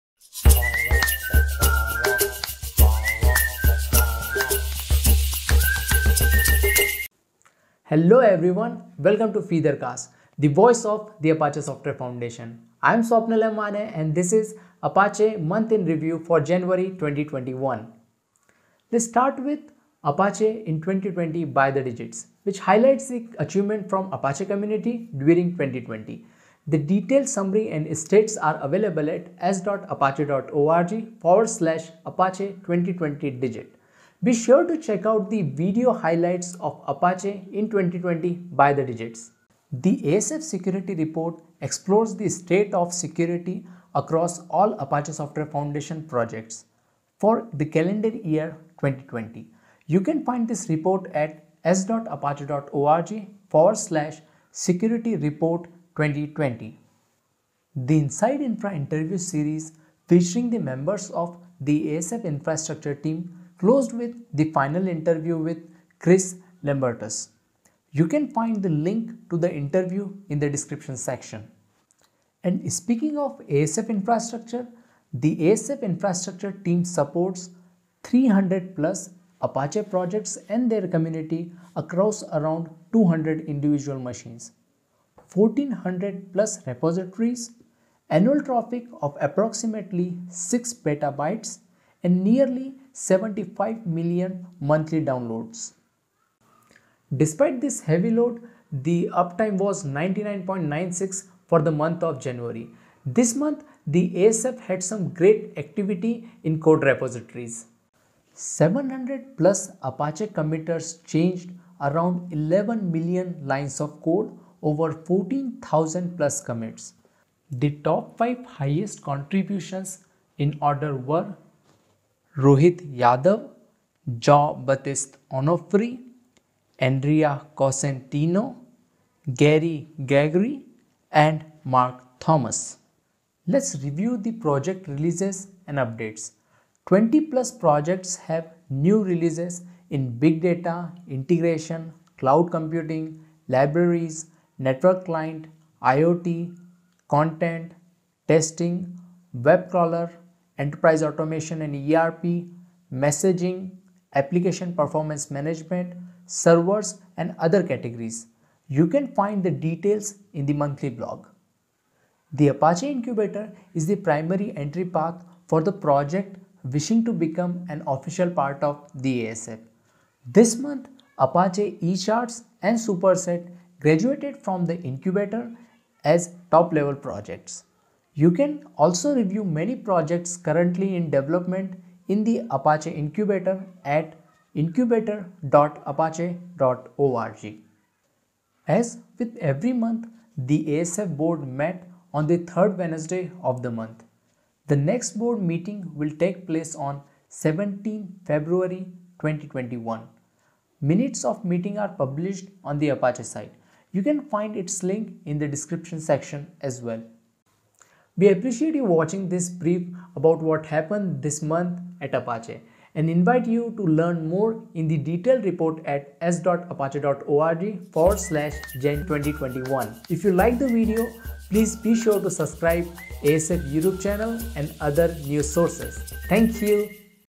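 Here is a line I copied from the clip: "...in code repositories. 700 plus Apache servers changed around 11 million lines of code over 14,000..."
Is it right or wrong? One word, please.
wrong.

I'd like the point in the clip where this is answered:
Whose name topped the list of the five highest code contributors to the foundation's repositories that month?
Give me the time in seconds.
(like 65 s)
122 s.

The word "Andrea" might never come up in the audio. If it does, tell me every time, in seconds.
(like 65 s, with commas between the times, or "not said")
126 s.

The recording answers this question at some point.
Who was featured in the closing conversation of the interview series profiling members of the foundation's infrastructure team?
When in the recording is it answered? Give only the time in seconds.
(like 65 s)
65 s.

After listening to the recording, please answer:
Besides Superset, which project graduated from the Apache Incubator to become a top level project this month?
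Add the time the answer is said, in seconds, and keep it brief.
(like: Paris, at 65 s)
Apache ECharts, at 171 s.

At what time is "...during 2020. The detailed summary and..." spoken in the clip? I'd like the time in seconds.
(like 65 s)
25 s.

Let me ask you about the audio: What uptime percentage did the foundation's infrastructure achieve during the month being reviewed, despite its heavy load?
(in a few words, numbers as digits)
99.96.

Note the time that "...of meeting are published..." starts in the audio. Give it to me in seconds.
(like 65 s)
201 s.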